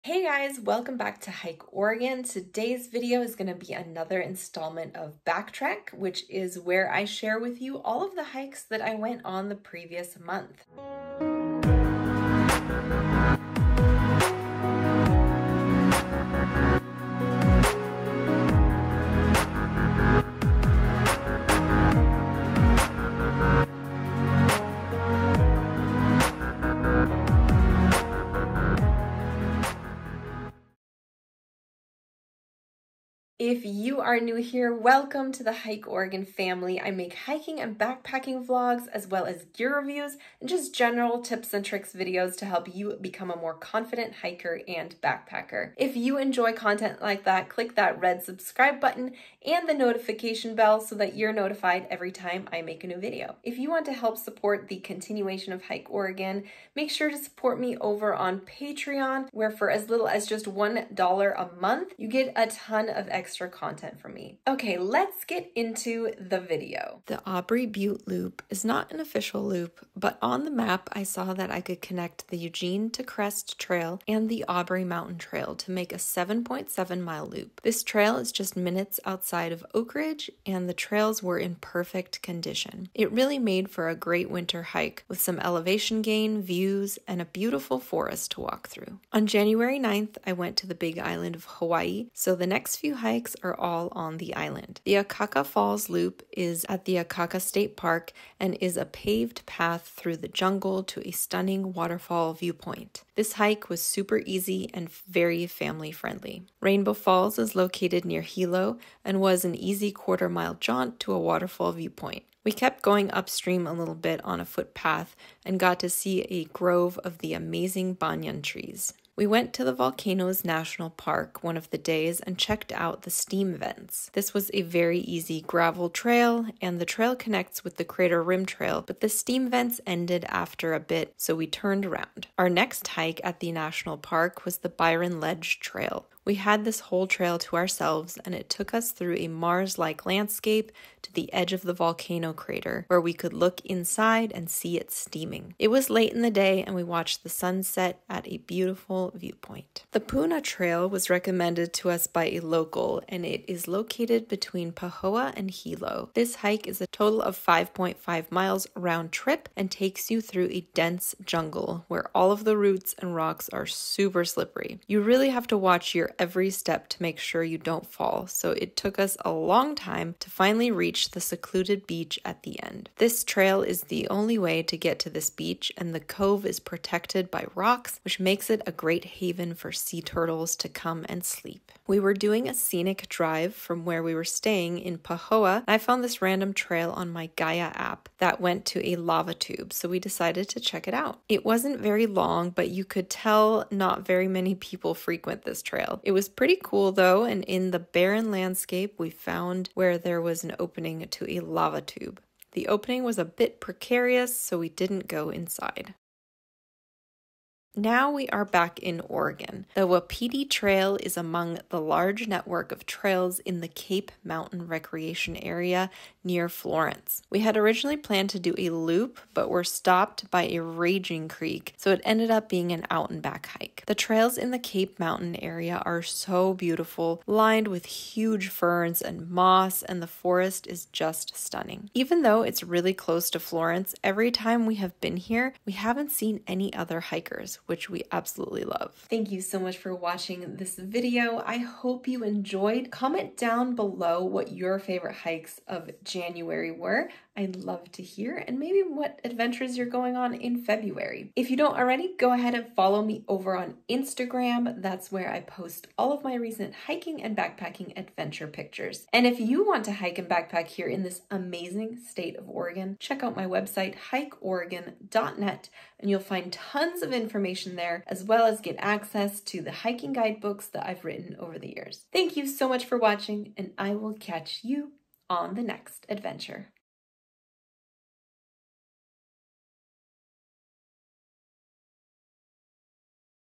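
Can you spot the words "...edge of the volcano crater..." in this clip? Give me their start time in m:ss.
2:21.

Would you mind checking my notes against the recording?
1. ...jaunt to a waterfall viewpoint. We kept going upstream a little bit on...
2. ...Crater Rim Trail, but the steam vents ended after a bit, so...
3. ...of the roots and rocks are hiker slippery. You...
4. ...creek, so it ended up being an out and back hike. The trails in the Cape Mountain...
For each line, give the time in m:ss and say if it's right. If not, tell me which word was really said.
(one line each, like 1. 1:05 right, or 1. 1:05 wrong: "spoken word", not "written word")
1. 1:50 right
2. 2:07 right
3. 2:42 wrong: "super", not "hiker"
4. 3:41 right.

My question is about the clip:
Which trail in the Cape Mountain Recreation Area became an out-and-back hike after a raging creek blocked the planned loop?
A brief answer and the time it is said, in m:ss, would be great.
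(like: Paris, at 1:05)
Wapiti Trail, at 3:29.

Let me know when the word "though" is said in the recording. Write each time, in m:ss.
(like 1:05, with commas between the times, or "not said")
3:16, 3:52.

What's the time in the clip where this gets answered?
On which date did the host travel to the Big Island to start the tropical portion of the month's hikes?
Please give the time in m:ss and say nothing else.
1:29.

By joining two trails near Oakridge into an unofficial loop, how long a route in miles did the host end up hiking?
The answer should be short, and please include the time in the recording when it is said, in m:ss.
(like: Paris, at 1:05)
7.7 miles, at 1:15.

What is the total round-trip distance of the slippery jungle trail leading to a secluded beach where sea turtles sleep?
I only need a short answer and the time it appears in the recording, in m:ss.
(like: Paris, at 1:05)
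5.5 miles, at 2:37.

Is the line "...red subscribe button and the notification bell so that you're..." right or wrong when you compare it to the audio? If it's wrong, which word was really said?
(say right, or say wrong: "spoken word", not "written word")
right.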